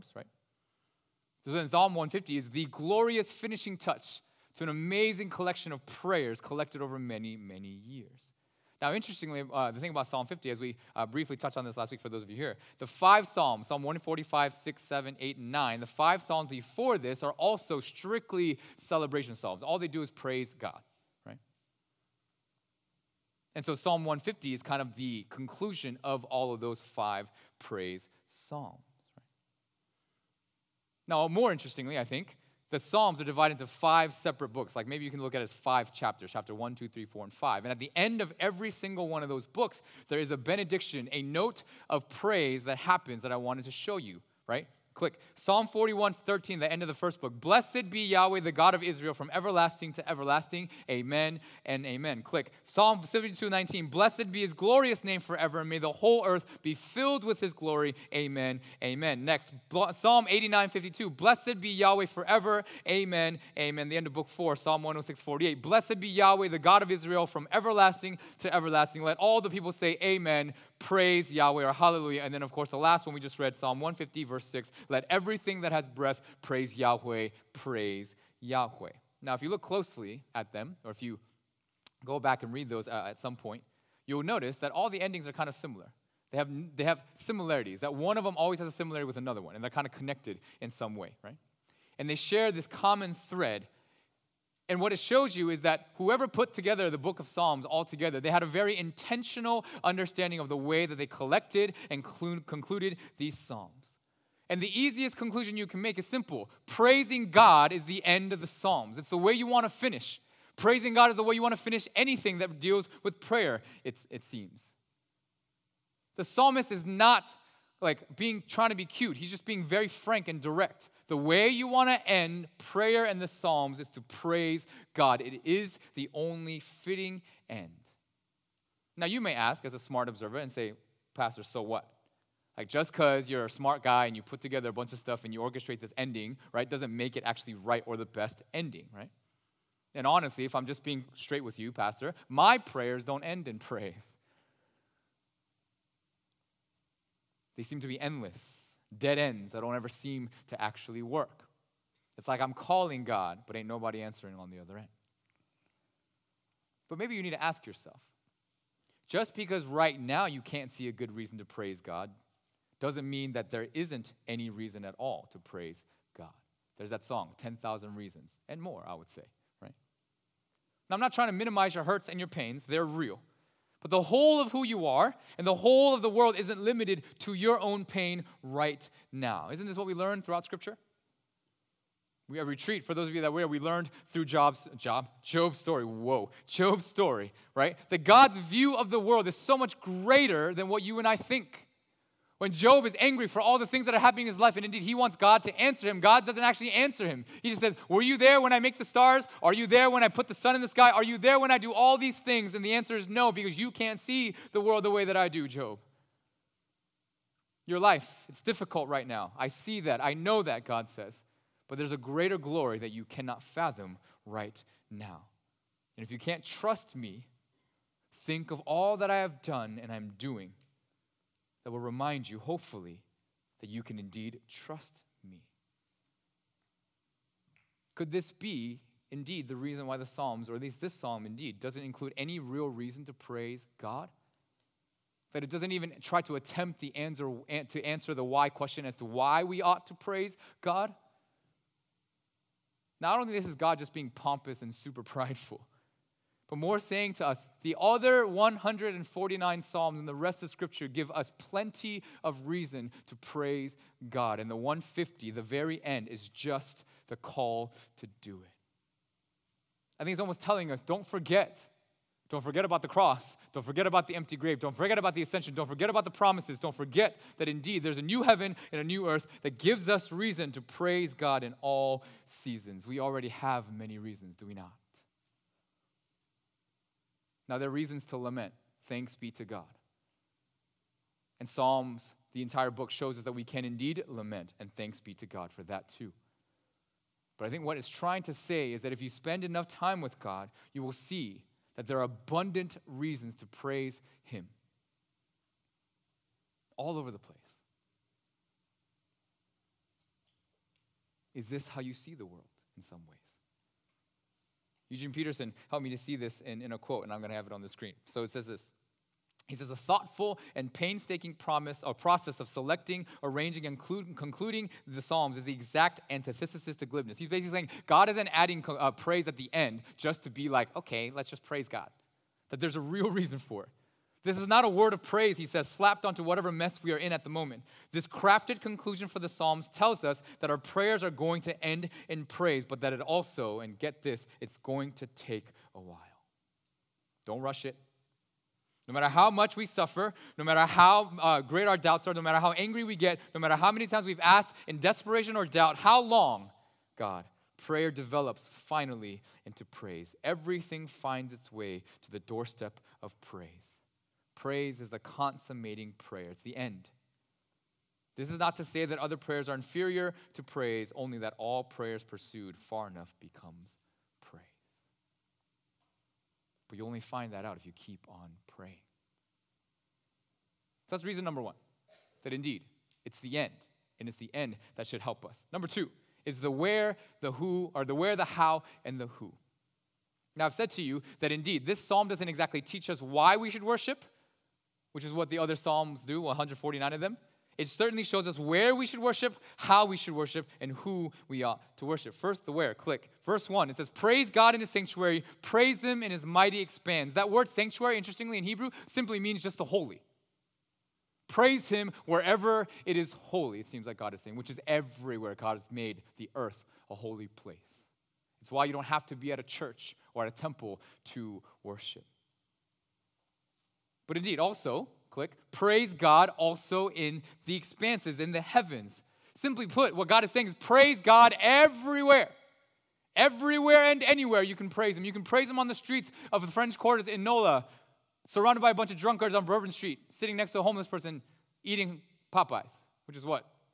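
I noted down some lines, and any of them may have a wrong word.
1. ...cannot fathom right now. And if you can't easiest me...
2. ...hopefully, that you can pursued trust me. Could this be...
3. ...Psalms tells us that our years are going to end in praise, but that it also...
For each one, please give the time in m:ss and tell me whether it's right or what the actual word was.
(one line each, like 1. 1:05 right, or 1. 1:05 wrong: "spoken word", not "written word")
1. 3:33 wrong: "trust", not "easiest"
2. 3:42 wrong: "indeed", not "pursued"
3. 5:29 wrong: "prayers", not "years".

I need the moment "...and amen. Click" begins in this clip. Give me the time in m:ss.
0:51.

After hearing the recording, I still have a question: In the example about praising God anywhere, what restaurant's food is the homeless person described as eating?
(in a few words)
Popeyes.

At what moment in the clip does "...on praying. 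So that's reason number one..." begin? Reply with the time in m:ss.
6:08.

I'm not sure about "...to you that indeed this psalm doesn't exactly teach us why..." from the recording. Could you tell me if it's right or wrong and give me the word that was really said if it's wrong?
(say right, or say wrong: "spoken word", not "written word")
right.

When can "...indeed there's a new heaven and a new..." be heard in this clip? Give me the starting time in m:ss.
4:27.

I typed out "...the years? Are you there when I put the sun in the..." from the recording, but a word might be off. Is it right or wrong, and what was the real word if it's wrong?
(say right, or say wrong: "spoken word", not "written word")
wrong: "stars", not "years".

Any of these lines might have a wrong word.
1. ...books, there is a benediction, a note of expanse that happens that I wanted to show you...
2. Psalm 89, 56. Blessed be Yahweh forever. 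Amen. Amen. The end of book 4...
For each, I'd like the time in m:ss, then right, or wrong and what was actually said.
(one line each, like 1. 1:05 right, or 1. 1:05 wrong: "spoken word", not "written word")
1. 0:39 wrong: "praise", not "expanse"
2. 0:59 wrong: "52", not "56".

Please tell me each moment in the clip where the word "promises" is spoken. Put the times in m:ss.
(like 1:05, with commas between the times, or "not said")
4:26, 5:11.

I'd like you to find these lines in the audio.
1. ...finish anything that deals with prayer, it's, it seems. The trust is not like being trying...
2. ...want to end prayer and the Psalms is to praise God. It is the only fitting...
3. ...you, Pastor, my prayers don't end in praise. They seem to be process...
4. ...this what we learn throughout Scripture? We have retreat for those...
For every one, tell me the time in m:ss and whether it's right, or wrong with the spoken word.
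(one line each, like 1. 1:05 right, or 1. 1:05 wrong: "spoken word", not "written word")
1. 1:51 wrong: "psalmist", not "trust"
2. 2:01 right
3. 2:21 wrong: "endless", not "process"
4. 2:59 right.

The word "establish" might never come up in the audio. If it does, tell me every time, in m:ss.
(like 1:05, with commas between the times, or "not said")
not said.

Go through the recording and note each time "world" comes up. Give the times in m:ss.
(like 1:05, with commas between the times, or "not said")
2:56, 3:08, 3:24, 5:02.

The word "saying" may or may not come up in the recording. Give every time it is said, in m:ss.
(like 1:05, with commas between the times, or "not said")
4:06, 5:17, 6:44, 7:00.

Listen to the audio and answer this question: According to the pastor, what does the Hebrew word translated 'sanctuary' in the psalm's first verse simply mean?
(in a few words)
the holy.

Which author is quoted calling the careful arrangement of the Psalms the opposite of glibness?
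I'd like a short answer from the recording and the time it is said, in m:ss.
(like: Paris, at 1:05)
Eugene Peterson, at 5:04.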